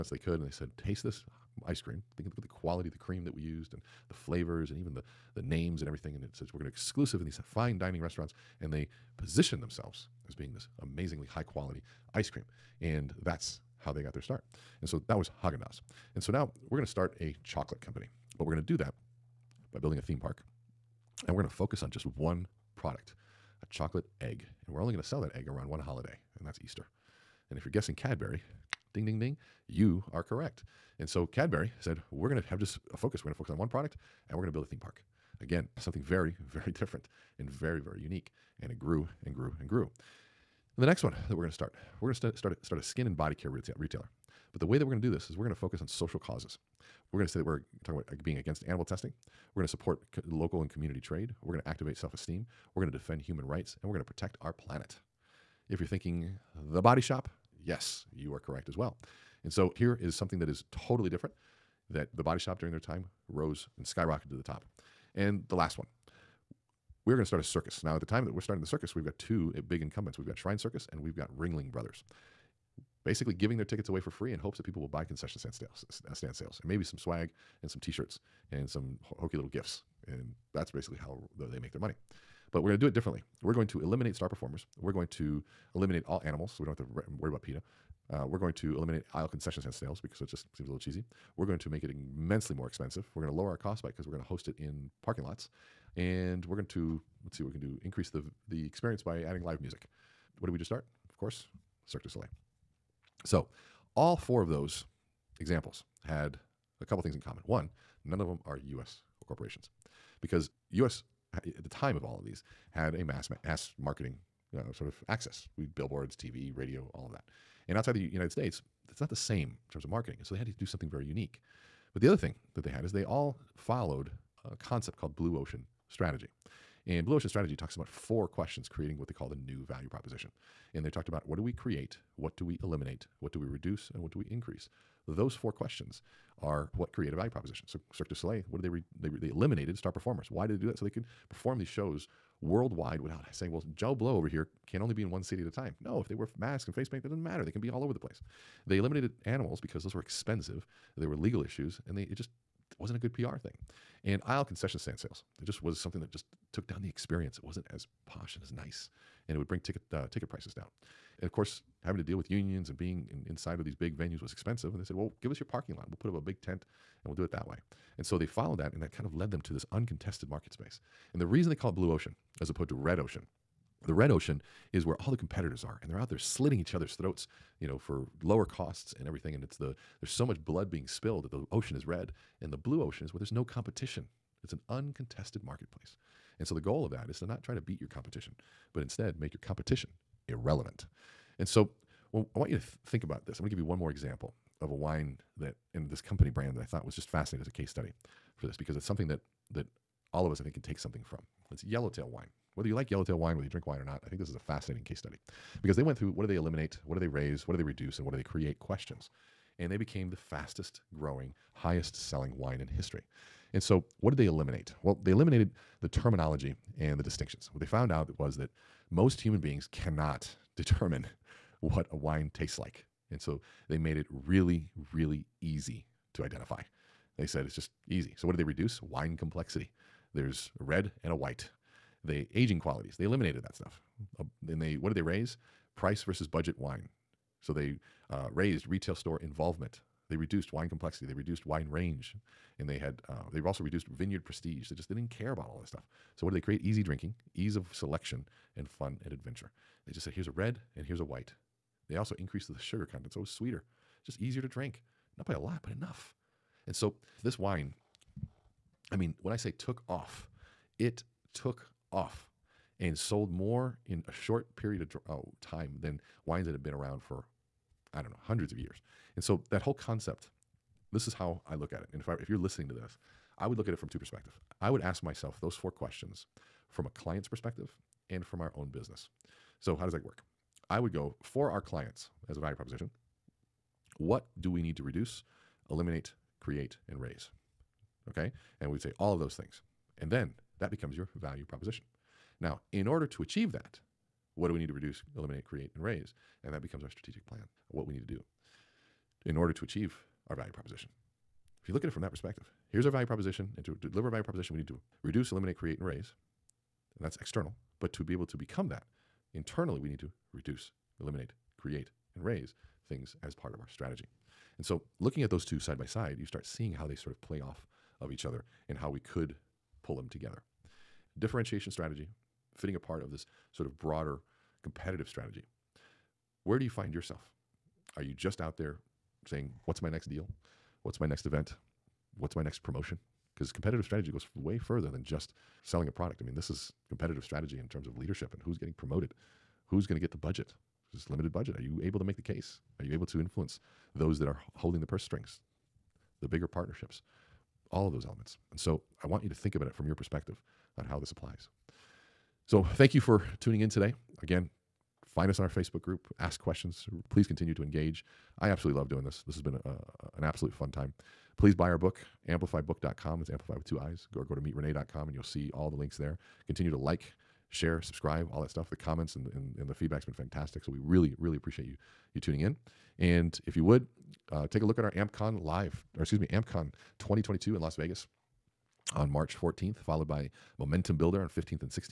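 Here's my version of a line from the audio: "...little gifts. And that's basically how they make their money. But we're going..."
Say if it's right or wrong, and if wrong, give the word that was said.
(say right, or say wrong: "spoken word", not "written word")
right.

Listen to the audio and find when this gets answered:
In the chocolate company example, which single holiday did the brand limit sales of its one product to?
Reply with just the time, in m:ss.
0:26.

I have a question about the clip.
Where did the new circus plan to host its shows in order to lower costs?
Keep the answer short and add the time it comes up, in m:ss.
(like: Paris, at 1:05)
Parking lots, at 1:35.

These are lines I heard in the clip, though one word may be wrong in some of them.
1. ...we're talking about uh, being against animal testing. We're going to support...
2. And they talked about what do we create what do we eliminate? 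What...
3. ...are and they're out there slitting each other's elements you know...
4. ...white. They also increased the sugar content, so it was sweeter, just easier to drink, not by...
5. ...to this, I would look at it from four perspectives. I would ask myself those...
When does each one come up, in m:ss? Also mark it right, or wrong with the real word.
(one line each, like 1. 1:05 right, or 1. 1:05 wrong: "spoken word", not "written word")
1. 0:47 right
2. 2:10 right
3. 2:55 wrong: "throats", not "elements"
4. 4:11 right
5. 4:32 wrong: "two", not "four".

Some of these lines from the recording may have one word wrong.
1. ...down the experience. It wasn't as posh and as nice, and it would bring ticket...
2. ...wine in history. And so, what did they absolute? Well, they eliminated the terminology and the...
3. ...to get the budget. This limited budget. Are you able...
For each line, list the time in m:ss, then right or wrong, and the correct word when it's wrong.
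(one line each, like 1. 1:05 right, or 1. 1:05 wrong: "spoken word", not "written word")
1. 2:36 right
2. 3:32 wrong: "eliminate", not "absolute"
3. 5:39 right.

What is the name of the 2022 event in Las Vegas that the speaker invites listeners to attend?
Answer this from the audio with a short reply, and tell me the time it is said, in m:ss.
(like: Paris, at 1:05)
AmpCon 2022, at 6:16.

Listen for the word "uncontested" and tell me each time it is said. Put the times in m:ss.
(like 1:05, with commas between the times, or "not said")
2:49, 3:04.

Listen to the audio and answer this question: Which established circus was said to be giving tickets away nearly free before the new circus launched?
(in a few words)
Ringling Brothers.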